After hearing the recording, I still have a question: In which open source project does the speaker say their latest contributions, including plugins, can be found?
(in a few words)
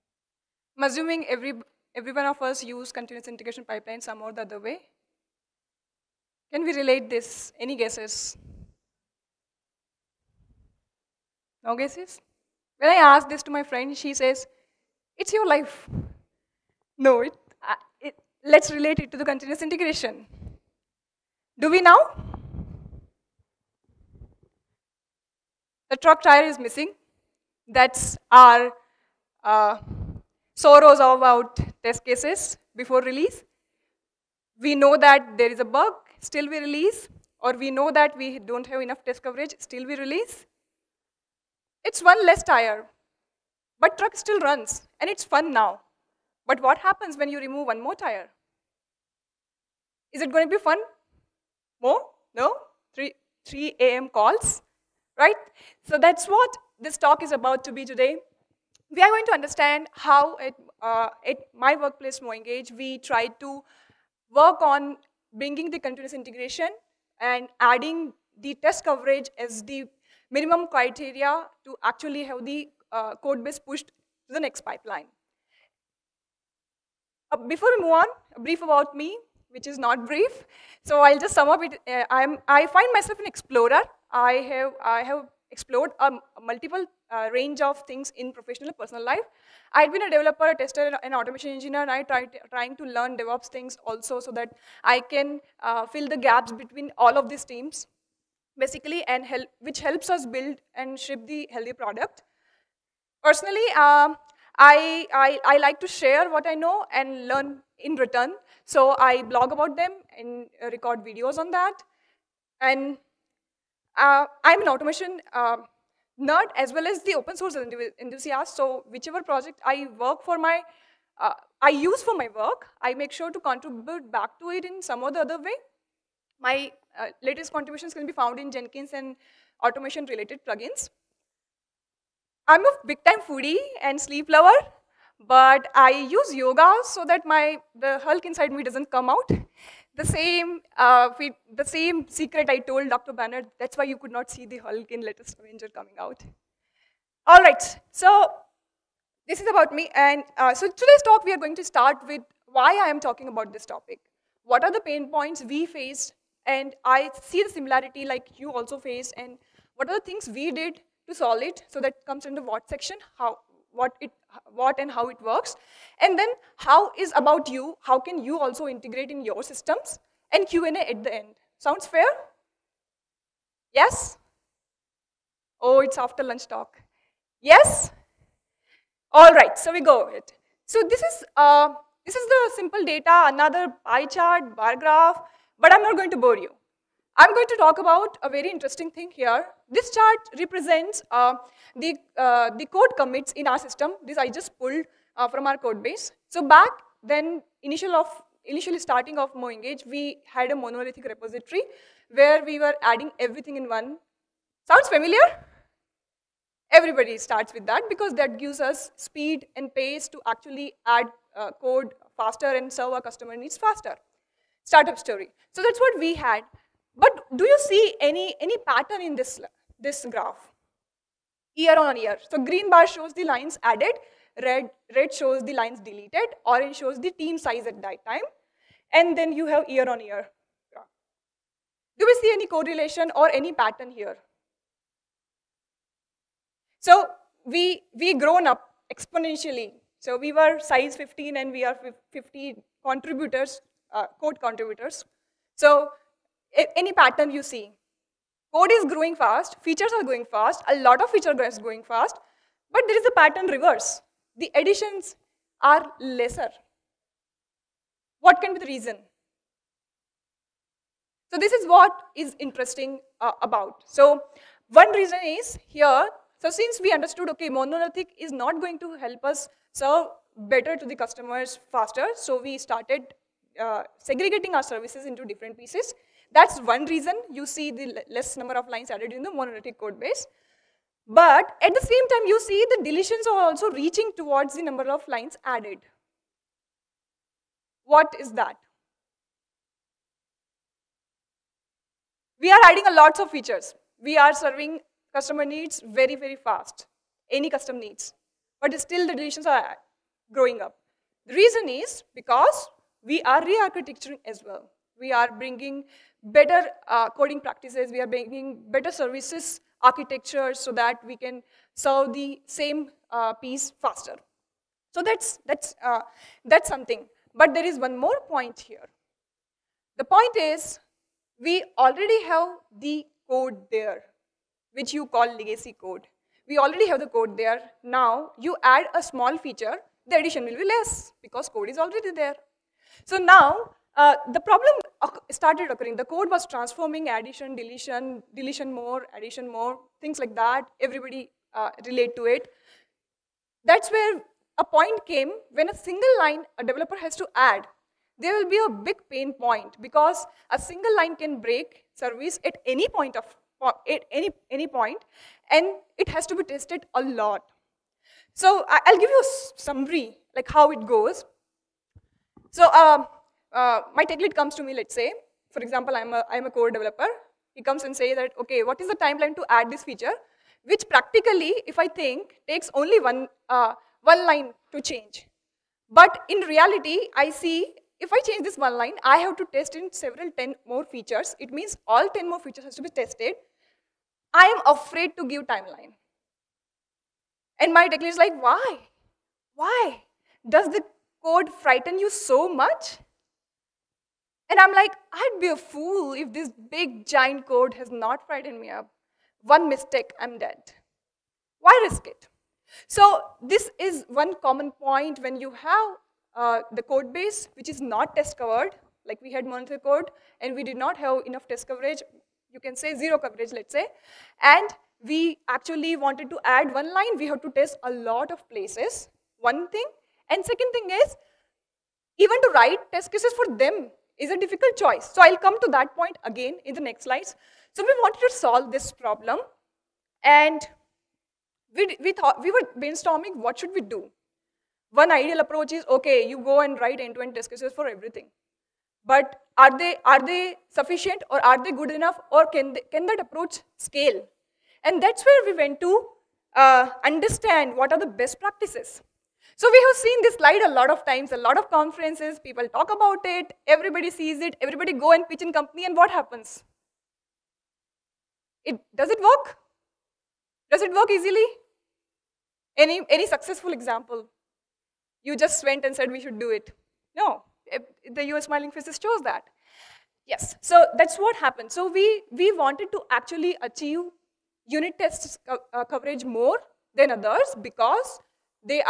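Jenkins.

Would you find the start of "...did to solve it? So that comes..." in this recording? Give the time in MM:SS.
02:40.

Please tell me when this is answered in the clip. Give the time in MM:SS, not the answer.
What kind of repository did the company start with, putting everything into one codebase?
03:20.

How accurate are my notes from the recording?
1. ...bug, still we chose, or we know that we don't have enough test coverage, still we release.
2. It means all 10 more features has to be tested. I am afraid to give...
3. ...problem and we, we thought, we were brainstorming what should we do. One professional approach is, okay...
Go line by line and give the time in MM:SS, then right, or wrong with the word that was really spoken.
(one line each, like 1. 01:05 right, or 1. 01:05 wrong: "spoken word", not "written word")
1. 00:35 wrong: "release", not "chose"
2. 06:21 right
3. 07:08 wrong: "ideal", not "professional".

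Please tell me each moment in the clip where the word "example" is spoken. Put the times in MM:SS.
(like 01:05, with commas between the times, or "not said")
06:05, 07:43.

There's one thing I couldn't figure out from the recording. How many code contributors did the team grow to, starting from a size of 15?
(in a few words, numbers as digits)
50.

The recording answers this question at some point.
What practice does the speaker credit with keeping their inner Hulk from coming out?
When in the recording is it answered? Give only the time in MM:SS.
02:16.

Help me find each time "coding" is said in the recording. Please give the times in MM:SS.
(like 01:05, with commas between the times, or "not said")
05:07.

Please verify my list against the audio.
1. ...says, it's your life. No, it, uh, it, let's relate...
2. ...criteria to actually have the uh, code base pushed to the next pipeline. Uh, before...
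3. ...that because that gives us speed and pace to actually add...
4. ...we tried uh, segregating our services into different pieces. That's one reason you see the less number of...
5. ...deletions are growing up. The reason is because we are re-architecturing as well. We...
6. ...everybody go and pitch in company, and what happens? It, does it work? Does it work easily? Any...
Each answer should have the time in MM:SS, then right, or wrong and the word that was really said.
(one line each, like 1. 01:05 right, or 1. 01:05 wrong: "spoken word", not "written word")
1. 00:14 right
2. 01:10 right
3. 03:27 right
4. 04:32 wrong: "started", not "tried"
5. 04:59 right
6. 07:34 right.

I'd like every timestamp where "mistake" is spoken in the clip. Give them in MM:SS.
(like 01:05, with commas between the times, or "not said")
06:39.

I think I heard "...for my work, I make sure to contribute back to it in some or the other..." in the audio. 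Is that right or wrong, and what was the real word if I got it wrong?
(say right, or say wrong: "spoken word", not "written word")
right.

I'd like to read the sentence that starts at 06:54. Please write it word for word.
And we actually wanted to add one line, we have to test a lot of places, one thing.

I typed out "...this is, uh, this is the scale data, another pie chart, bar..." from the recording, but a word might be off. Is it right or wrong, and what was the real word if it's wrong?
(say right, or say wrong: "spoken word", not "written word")
wrong: "simple", not "scale".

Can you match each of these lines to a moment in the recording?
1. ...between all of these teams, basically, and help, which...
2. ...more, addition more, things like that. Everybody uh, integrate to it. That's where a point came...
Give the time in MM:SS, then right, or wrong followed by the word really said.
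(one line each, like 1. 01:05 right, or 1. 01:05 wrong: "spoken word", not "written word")
1. 01:36 right
2. 05:38 wrong: "relate", not "integrate".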